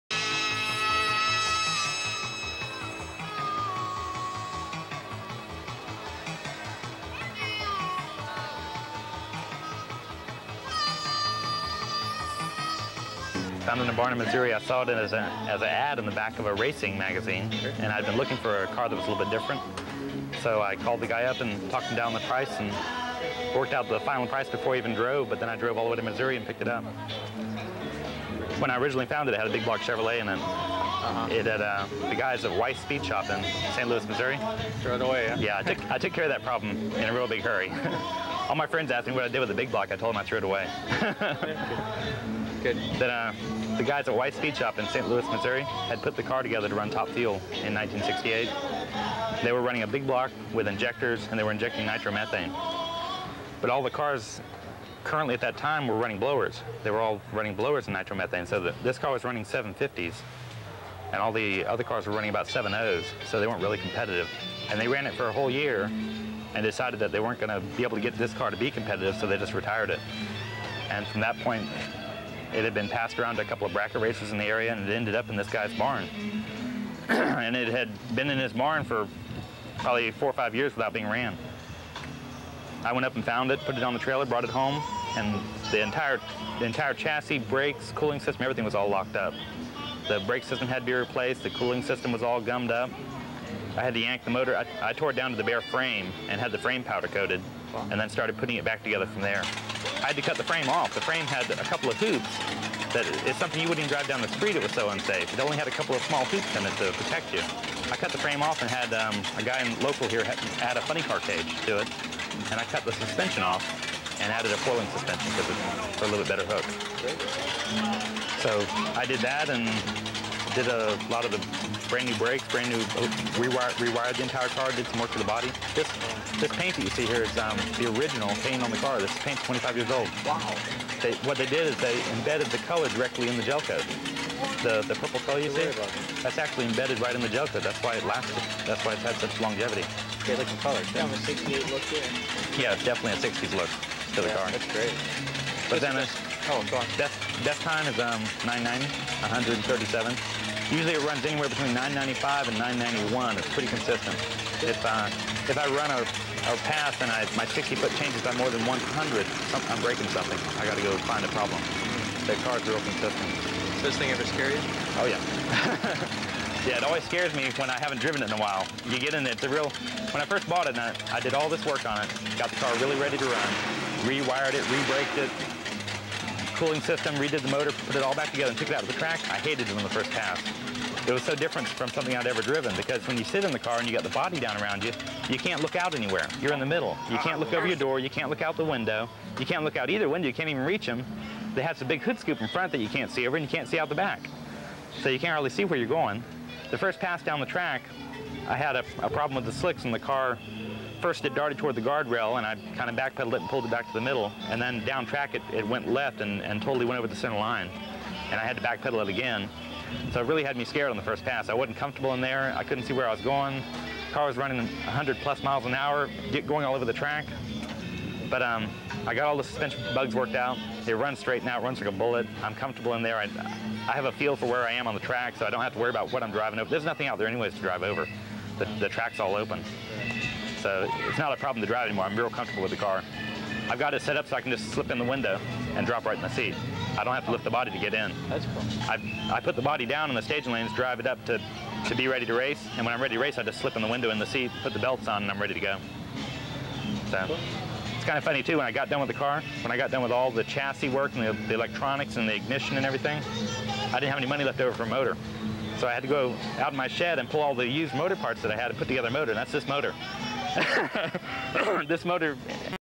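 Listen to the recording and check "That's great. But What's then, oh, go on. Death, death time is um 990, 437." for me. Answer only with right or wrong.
wrong.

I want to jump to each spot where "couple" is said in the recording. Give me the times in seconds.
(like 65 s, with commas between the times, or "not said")
73 s, 101 s, 105 s.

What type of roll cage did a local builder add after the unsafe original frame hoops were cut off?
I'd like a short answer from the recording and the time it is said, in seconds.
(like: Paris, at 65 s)
funny car cage, at 110 s.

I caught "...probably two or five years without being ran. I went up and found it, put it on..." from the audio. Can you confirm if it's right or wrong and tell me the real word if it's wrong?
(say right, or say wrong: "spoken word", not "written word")
wrong: "four", not "two".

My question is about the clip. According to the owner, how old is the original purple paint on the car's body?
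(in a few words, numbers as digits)
25 years.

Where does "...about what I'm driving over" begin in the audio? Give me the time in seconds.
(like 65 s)
225 s.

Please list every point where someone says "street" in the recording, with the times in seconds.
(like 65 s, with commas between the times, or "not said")
104 s.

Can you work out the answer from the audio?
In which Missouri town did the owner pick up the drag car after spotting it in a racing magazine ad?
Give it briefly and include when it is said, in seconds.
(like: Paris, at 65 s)
Barnum, at 13 s.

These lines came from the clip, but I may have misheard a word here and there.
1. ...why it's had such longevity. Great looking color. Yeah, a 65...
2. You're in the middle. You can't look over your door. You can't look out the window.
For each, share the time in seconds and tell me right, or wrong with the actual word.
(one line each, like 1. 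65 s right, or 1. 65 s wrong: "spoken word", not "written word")
1. 138 s wrong: "68", not "65"
2. 186 s right.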